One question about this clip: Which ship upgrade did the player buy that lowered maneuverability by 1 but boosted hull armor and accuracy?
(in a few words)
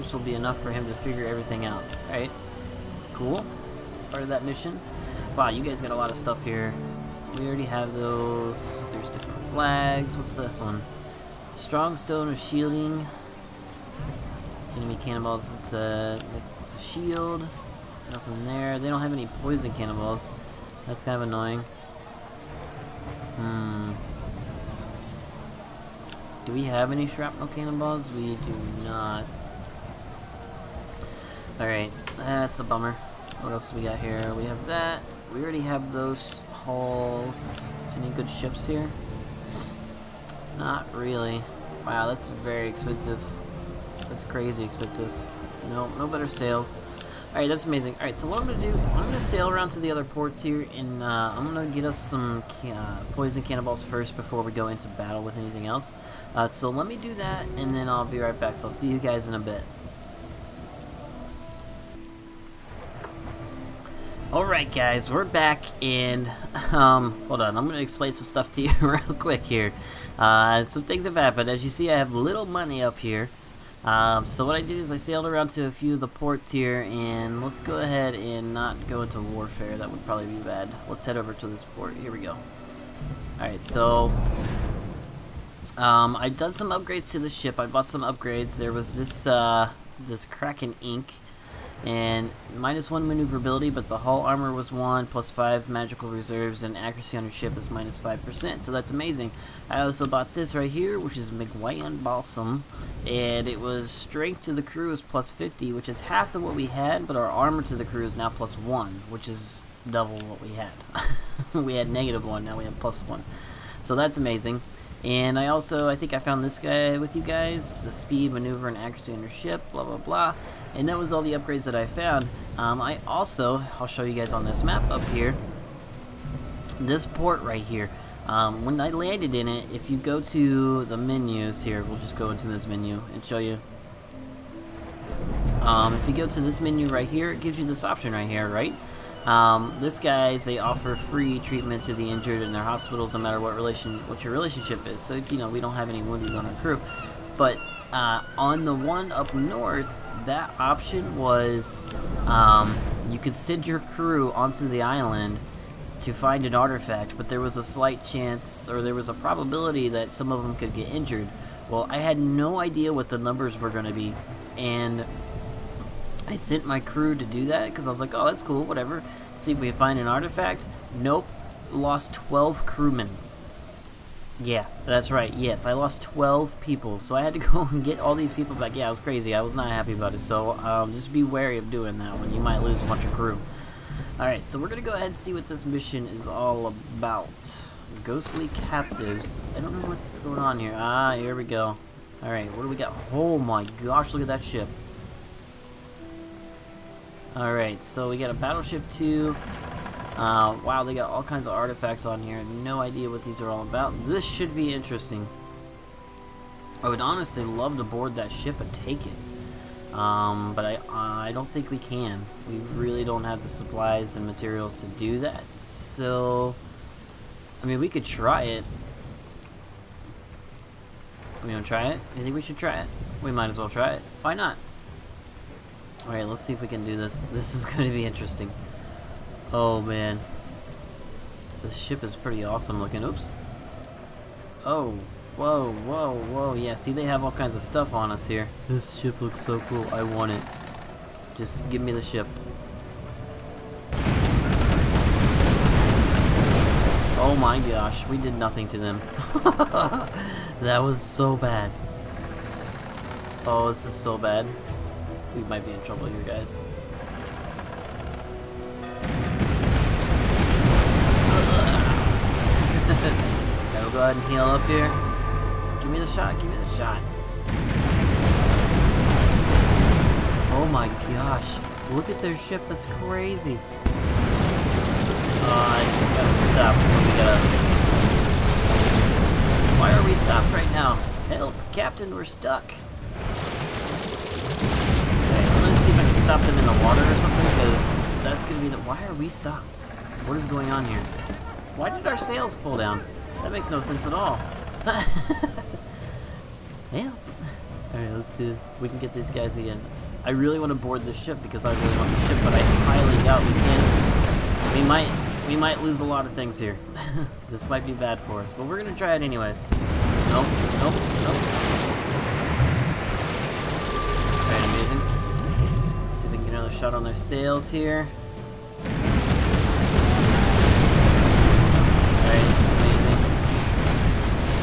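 Kraken Ink.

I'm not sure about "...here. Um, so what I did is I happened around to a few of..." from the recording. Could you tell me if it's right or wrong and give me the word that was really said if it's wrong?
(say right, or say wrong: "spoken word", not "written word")
wrong: "sailed", not "happened".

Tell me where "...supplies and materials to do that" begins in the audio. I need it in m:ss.
3:33.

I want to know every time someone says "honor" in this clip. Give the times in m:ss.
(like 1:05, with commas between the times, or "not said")
not said.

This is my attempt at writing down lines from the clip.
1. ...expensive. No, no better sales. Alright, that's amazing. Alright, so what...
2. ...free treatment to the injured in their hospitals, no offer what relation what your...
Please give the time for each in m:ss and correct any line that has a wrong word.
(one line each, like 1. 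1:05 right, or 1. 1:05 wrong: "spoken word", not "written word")
1. 0:44 right
2. 2:20 wrong: "matter", not "offer".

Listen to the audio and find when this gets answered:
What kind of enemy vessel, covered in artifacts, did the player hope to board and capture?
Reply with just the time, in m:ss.
3:18.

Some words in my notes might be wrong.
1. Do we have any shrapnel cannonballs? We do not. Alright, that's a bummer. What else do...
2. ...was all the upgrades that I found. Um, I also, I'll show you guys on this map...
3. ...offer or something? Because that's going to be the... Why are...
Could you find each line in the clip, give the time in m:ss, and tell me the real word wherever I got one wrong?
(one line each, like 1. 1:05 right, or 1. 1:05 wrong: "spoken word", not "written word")
1. 0:26 right
2. 2:00 right
3. 4:46 wrong: "water", not "offer".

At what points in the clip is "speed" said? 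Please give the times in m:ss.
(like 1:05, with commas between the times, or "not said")
1:57.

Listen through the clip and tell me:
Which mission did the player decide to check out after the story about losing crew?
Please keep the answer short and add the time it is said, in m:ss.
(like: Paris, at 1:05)
Ghostly captives, at 3:08.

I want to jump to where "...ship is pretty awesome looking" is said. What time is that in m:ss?
3:51.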